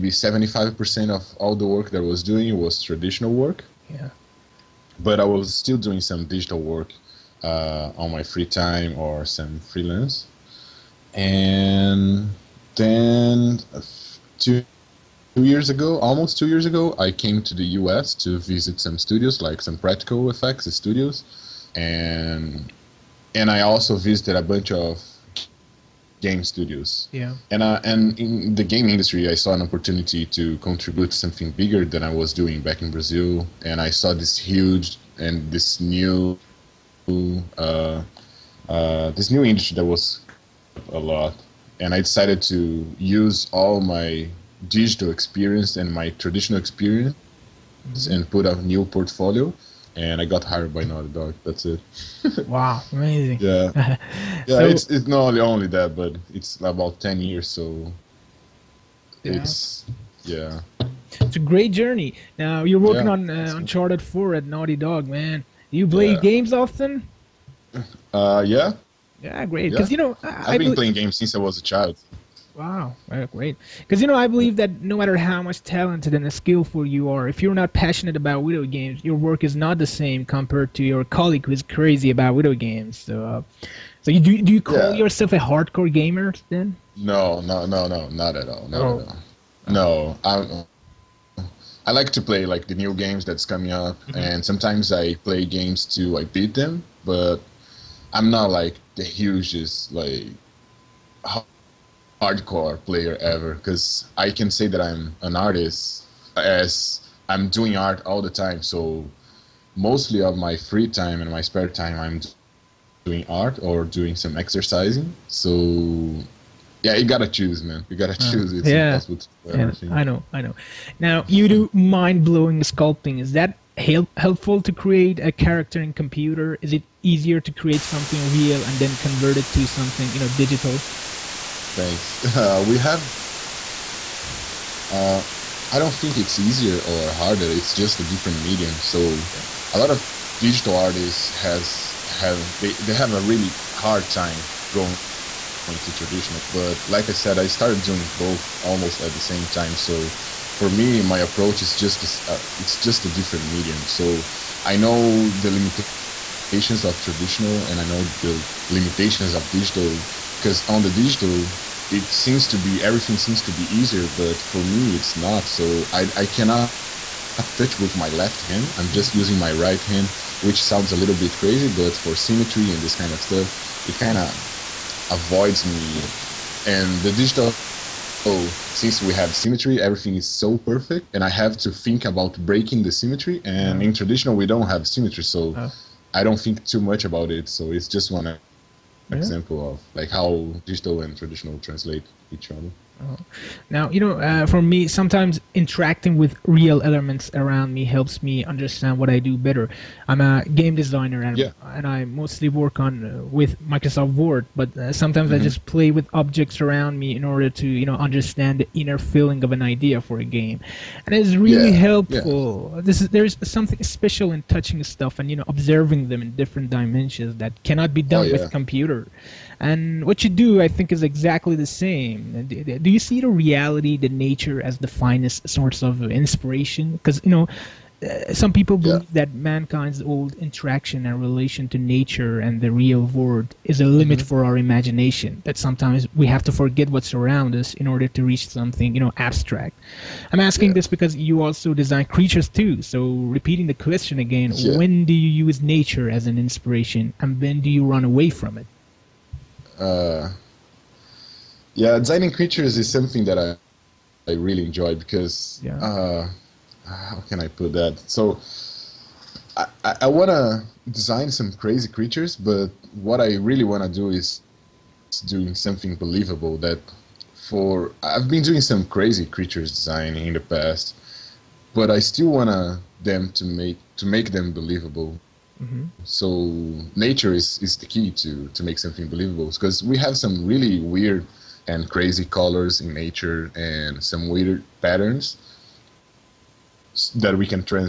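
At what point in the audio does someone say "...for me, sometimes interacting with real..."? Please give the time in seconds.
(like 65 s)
194 s.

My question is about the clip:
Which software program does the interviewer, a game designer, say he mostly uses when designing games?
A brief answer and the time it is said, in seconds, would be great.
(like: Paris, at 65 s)
Microsoft Word, at 203 s.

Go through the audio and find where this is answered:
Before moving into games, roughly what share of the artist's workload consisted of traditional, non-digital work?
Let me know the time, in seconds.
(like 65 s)
0 s.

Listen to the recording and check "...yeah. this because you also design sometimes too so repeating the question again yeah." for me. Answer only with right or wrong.
wrong.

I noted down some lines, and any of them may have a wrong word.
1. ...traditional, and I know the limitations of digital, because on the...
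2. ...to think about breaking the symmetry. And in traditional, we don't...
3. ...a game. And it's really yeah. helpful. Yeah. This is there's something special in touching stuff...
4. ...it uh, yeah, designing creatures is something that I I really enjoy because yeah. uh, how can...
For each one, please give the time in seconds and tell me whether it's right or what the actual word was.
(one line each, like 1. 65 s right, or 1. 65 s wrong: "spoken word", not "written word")
1. 157 s right
2. 181 s right
3. 210 s right
4. 248 s right.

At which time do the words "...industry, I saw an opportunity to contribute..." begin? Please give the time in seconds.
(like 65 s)
28 s.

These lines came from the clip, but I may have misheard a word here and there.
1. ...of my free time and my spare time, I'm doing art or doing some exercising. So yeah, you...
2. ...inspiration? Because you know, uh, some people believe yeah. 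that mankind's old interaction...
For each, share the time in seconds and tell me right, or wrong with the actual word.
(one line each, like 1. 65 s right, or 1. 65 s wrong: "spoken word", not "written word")
1. 110 s right
2. 226 s right.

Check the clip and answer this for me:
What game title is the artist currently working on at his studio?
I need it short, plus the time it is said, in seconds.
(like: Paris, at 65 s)
Uncharted 4, at 63 s.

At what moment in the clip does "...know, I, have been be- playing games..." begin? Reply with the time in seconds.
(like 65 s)
70 s.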